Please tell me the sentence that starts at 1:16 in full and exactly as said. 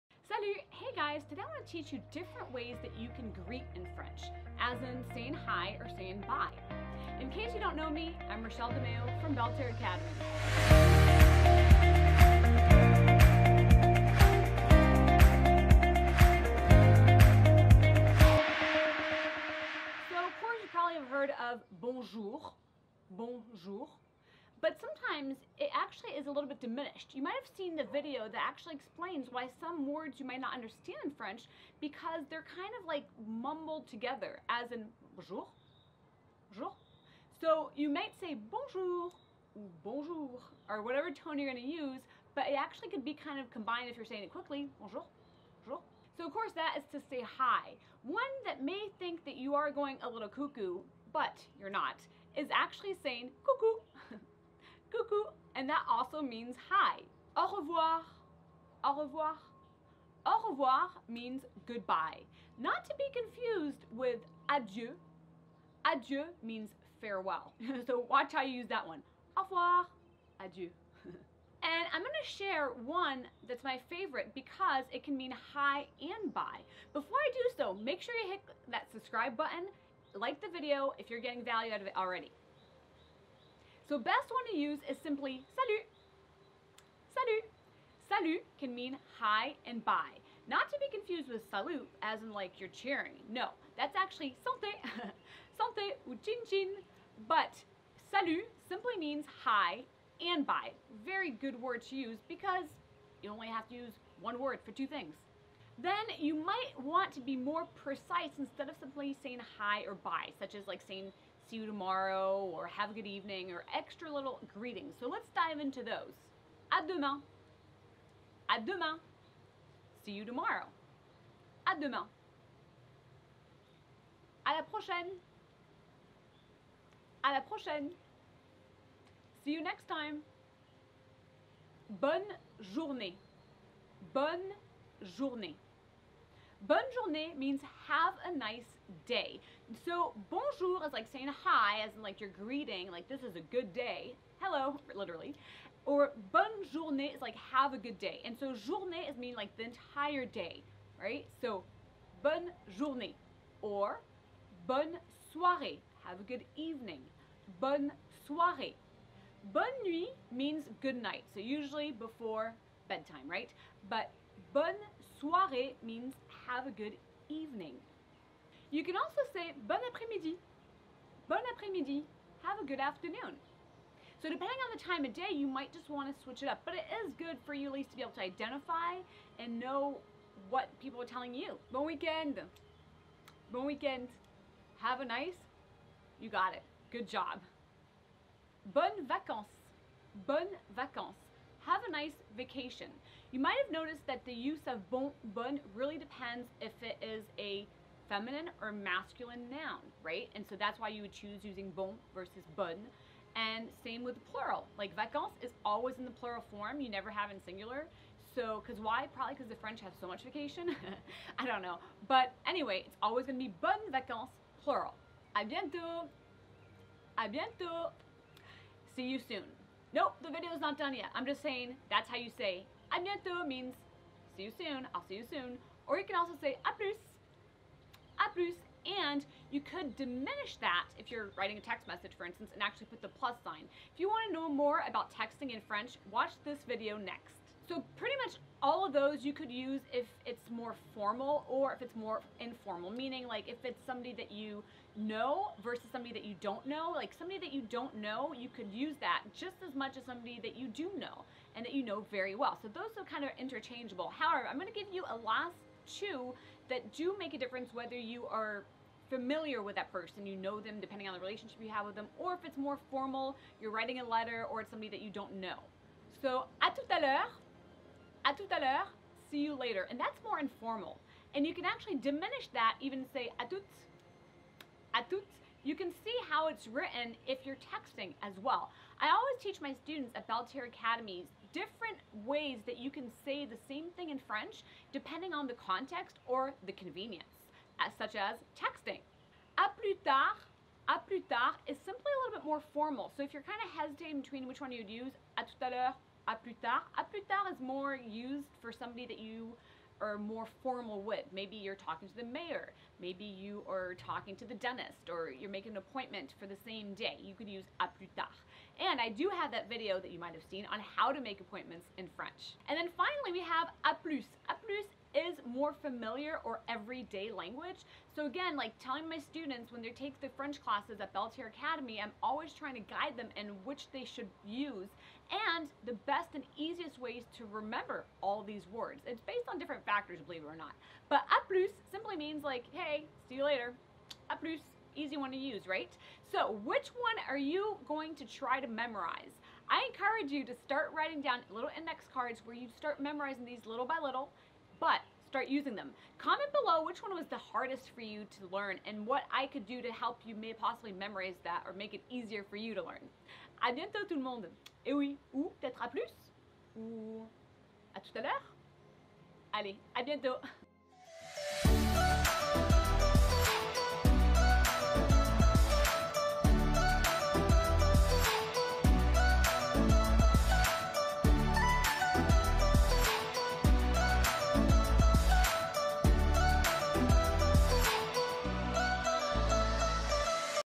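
Before I do so, make sure you hit that subscribe button, like the video if you're getting value out of it already.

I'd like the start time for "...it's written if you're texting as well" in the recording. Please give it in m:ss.
4:36.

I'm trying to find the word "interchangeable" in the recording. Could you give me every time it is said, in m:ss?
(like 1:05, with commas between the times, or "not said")
4:13.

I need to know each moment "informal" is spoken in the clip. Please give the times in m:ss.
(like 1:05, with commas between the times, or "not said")
4:02, 4:30.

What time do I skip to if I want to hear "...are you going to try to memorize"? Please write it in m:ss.
5:37.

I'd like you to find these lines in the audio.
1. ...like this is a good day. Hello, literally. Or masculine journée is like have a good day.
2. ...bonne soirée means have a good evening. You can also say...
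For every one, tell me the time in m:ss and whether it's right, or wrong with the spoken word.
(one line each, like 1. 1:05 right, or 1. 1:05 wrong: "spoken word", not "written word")
1. 2:22 wrong: "bonne", not "masculine"
2. 2:44 right.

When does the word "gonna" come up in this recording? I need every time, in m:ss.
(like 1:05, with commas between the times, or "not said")
0:41, 3:33.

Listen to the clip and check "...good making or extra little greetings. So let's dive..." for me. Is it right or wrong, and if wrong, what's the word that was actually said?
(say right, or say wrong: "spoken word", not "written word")
wrong: "evening", not "making".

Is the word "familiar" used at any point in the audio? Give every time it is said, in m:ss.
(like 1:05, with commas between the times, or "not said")
4:19, 5:15.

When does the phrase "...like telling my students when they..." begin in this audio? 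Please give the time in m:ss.
5:18.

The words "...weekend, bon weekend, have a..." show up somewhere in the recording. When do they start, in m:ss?
3:01.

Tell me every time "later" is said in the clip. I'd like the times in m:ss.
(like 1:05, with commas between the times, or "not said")
4:29, 5:33.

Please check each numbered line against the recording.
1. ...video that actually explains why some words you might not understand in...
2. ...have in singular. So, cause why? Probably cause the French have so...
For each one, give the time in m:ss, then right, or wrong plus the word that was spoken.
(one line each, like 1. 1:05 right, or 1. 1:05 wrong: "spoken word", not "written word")
1. 0:27 right
2. 3:27 right.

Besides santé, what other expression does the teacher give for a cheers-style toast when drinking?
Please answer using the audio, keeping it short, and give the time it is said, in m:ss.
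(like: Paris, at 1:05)
chin chin, at 1:36.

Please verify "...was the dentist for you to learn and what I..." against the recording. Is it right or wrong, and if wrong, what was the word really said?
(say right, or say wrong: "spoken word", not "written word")
wrong: "hardest", not "dentist".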